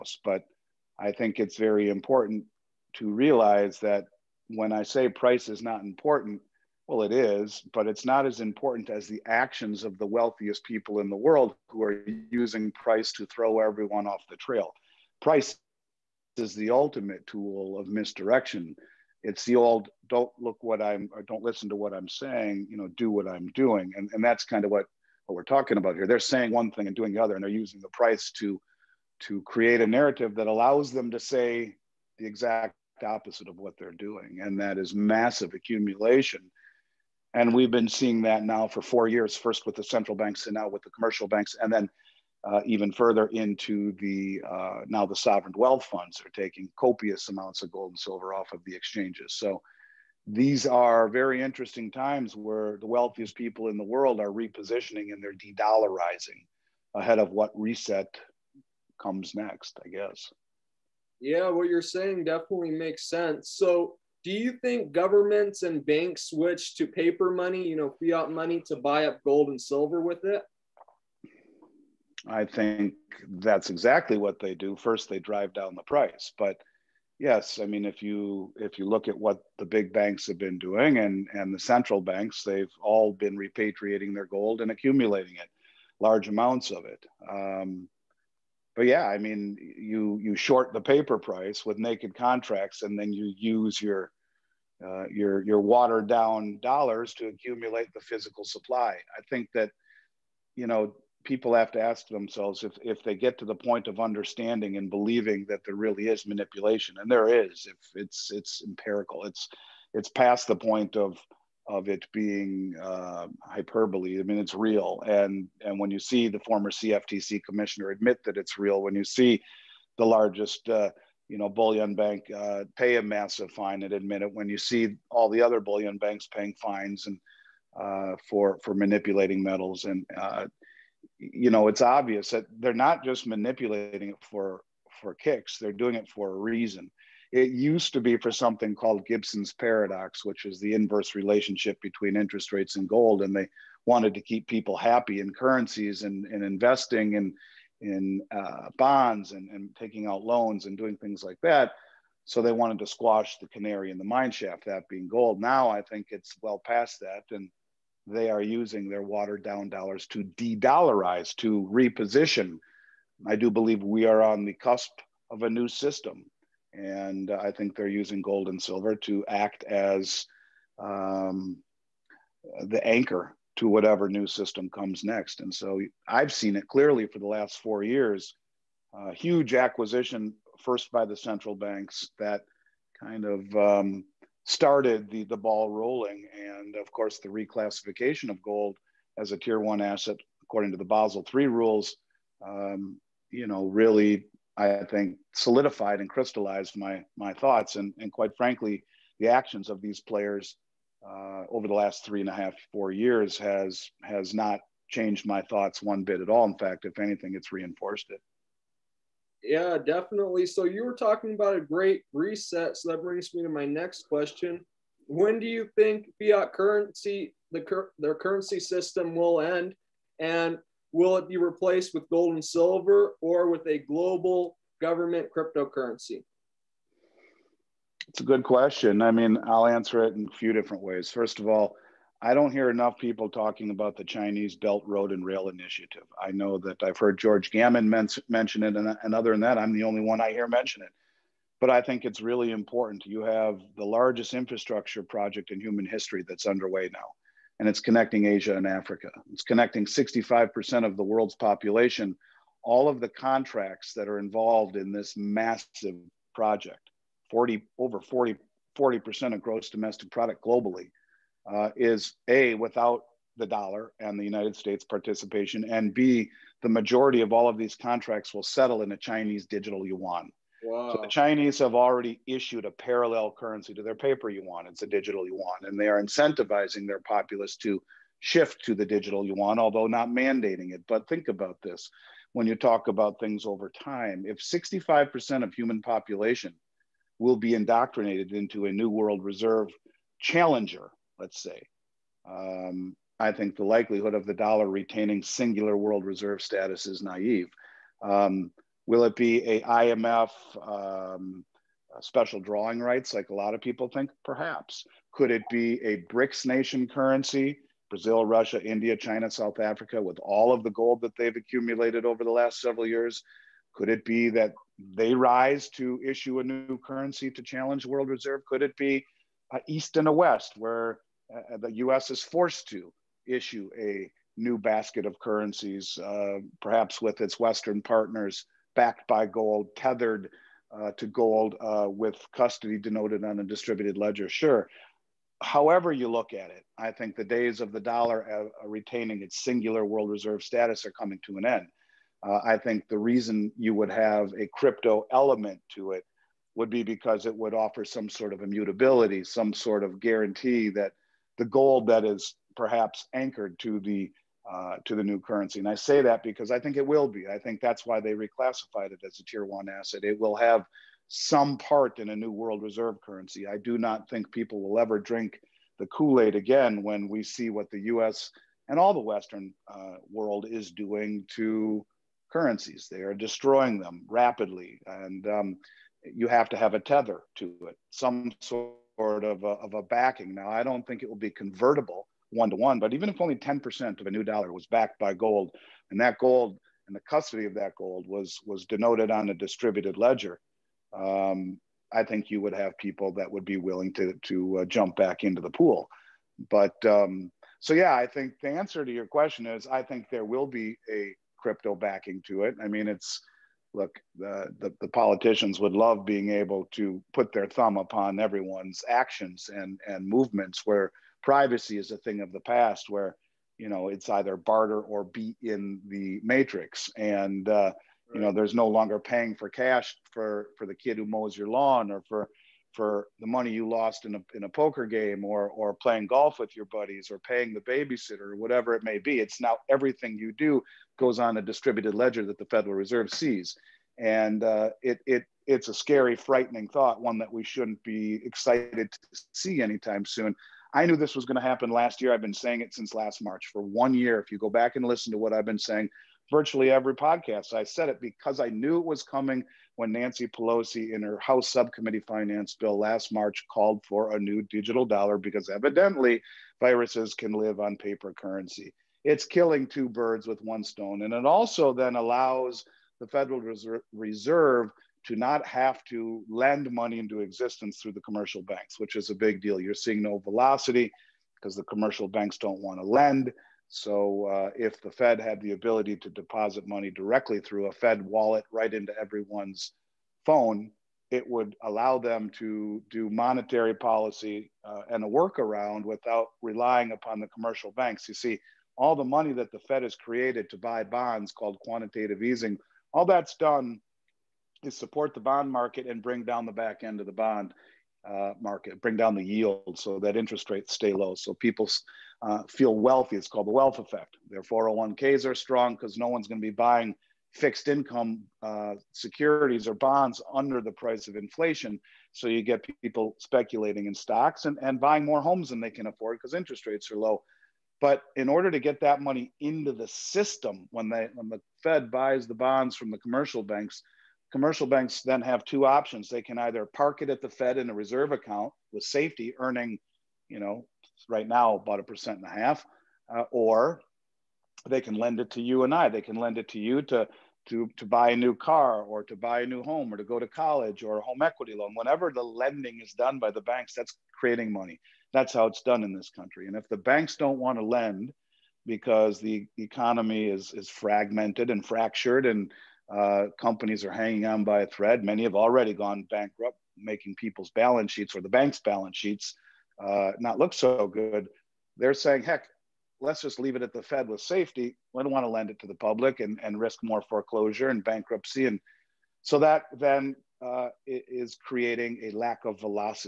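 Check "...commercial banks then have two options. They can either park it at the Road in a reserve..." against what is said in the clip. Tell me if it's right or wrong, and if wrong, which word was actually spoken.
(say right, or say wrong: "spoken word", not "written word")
wrong: "Fed", not "Road".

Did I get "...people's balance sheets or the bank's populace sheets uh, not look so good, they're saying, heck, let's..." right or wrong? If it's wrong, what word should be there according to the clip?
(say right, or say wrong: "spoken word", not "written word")
wrong: "balance", not "populace".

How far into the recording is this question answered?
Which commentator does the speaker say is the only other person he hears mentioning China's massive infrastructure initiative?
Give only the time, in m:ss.
3:57.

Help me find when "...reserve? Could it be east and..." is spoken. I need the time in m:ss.
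5:18.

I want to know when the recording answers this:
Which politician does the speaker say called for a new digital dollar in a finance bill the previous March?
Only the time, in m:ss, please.
7:29.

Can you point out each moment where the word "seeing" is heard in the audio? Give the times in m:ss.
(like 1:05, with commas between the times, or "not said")
0:37, 7:49.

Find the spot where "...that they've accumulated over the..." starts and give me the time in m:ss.
5:11.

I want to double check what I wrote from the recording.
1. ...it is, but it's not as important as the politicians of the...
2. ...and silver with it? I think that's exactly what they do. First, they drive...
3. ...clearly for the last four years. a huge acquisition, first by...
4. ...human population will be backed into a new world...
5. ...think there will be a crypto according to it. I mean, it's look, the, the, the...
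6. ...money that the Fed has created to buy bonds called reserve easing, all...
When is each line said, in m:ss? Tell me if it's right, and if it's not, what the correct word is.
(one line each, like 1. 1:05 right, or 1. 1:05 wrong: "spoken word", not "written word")
1. 0:07 wrong: "actions", not "politicians"
2. 1:09 right
3. 2:56 right
4. 4:45 wrong: "indoctrinated", not "backed"
5. 6:39 wrong: "backing", not "according"
6. 8:09 wrong: "quantitative", not "reserve".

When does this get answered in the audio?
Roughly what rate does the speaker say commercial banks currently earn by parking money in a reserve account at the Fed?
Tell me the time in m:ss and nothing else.
8:51.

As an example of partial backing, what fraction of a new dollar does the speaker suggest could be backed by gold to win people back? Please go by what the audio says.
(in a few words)
10%.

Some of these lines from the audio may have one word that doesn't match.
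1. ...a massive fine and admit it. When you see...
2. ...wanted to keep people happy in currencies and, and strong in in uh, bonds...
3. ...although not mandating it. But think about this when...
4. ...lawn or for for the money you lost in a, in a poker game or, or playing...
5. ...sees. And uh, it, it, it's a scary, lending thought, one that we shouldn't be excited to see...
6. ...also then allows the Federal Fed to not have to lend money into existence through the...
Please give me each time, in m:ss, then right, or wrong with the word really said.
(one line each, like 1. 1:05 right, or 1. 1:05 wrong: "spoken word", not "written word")
1. 2:02 right
2. 2:23 wrong: "investing", not "strong"
3. 4:39 right
4. 7:01 right
5. 7:13 wrong: "frightening", not "lending"
6. 7:41 wrong: "Reserve", not "Fed".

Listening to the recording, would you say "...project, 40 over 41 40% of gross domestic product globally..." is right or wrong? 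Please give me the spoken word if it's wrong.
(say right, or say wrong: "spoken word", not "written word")
wrong: "40", not "41".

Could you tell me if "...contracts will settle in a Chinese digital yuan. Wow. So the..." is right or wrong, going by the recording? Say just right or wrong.
right.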